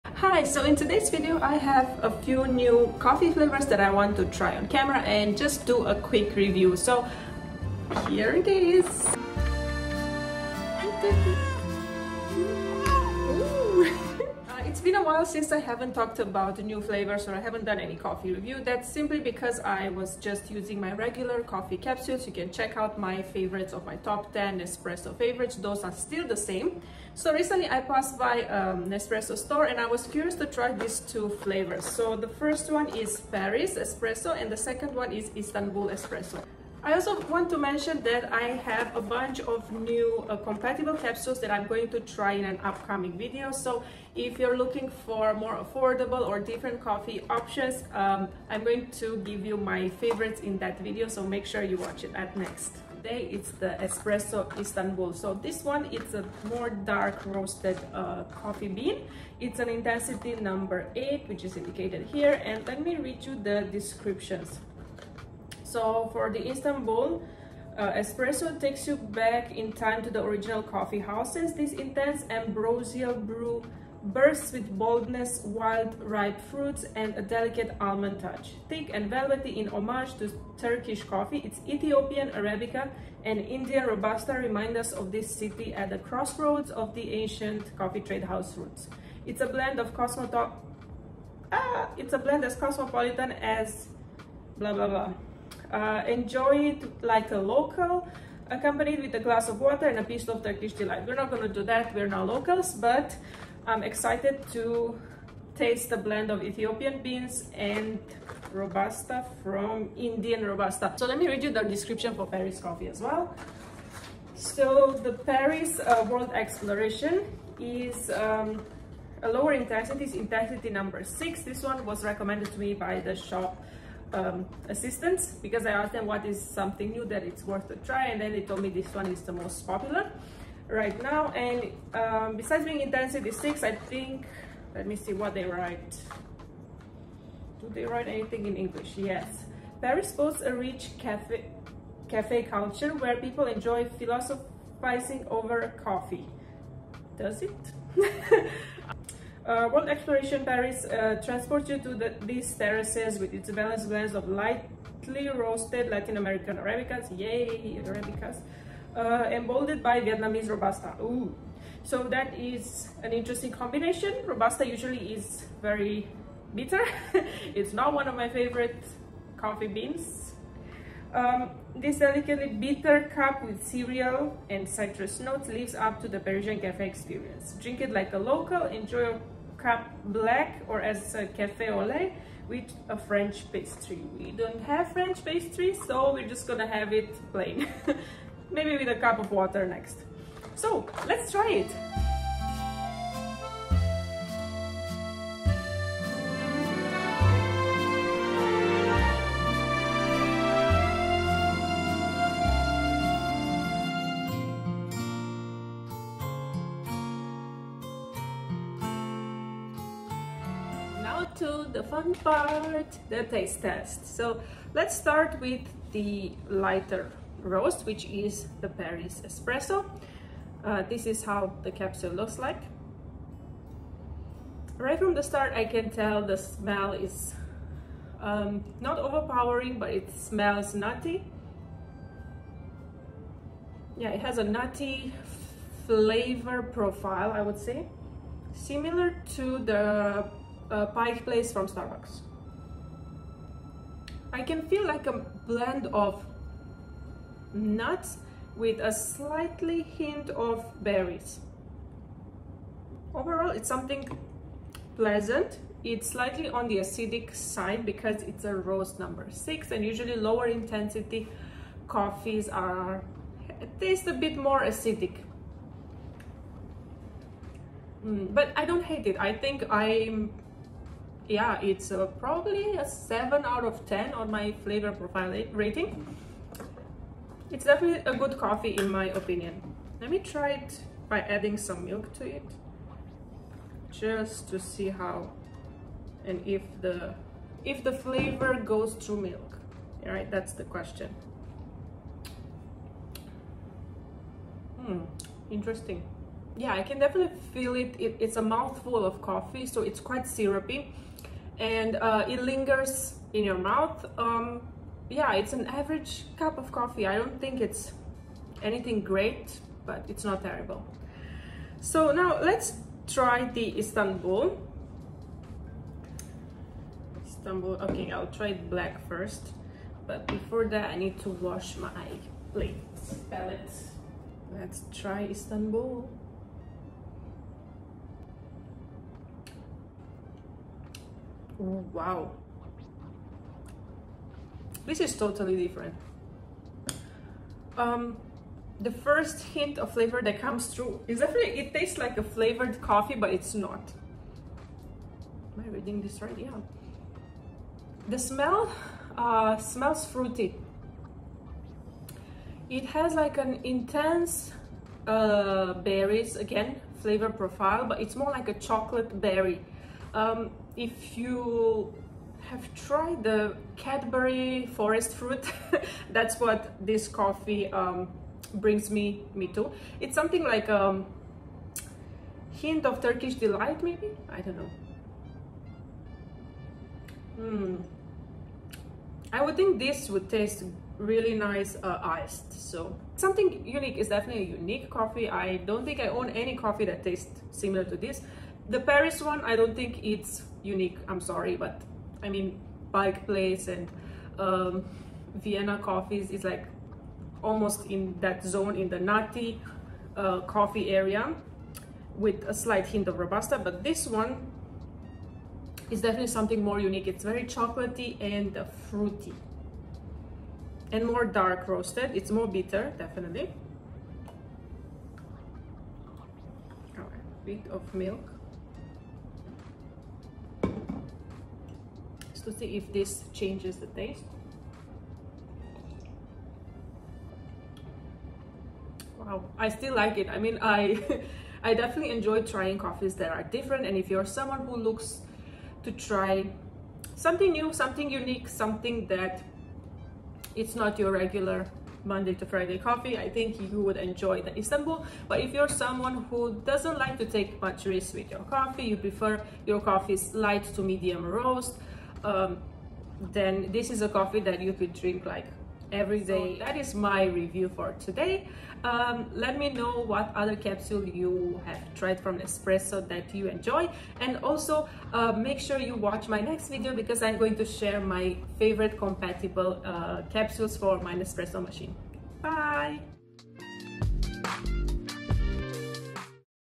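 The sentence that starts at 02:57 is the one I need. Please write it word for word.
Drink it like a local, enjoy your cup black or as a cafe au lait with a French pastry.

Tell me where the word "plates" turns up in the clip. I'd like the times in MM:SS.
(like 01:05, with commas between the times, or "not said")
05:22.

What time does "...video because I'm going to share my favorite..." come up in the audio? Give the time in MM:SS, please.
07:46.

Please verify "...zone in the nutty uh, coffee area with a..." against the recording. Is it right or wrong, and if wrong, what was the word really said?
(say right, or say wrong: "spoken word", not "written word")
right.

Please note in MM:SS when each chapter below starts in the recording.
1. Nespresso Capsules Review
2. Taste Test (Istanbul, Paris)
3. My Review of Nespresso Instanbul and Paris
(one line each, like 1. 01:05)
1. 00:54
2. 03:27
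3. 07:00.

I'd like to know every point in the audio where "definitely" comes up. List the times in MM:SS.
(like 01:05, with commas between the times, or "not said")
04:37, 04:56, 05:41, 06:24, 06:46, 06:52, 07:11.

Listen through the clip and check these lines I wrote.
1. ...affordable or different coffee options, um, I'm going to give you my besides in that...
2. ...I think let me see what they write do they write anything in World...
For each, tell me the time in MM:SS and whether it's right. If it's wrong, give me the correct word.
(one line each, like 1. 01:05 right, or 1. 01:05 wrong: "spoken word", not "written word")
1. 00:45 wrong: "favorites", not "besides"
2. 02:13 wrong: "English", not "World".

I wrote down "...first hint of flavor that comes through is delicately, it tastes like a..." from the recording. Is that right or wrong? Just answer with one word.
wrong.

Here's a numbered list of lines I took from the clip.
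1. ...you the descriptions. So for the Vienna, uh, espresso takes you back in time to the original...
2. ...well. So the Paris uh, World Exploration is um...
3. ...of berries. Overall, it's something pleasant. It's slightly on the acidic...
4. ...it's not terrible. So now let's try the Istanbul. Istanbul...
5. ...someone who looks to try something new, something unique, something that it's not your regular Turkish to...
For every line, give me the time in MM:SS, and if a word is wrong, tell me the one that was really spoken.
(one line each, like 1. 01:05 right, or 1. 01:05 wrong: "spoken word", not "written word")
1. 01:03 wrong: "Istanbul", not "Vienna"
2. 01:53 right
3. 04:10 right
4. 05:10 right
5. 07:14 wrong: "Monday", not "Turkish".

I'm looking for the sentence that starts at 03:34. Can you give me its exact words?
So let's start with the lighter roast, which is the Paris Espresso.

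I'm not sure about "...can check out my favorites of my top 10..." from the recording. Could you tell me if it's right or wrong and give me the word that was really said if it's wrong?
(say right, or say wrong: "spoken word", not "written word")
right.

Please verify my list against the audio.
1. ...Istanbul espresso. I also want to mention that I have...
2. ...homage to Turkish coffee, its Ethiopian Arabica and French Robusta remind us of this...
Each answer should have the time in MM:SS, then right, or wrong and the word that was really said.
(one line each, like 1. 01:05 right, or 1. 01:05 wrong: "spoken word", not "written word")
1. 00:35 right
2. 01:19 wrong: "Indian", not "French".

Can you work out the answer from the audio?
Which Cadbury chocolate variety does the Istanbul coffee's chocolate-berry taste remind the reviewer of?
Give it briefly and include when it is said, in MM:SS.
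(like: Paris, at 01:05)
Forest fruit, at 06:04.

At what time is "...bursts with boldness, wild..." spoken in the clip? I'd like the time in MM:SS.
01:14.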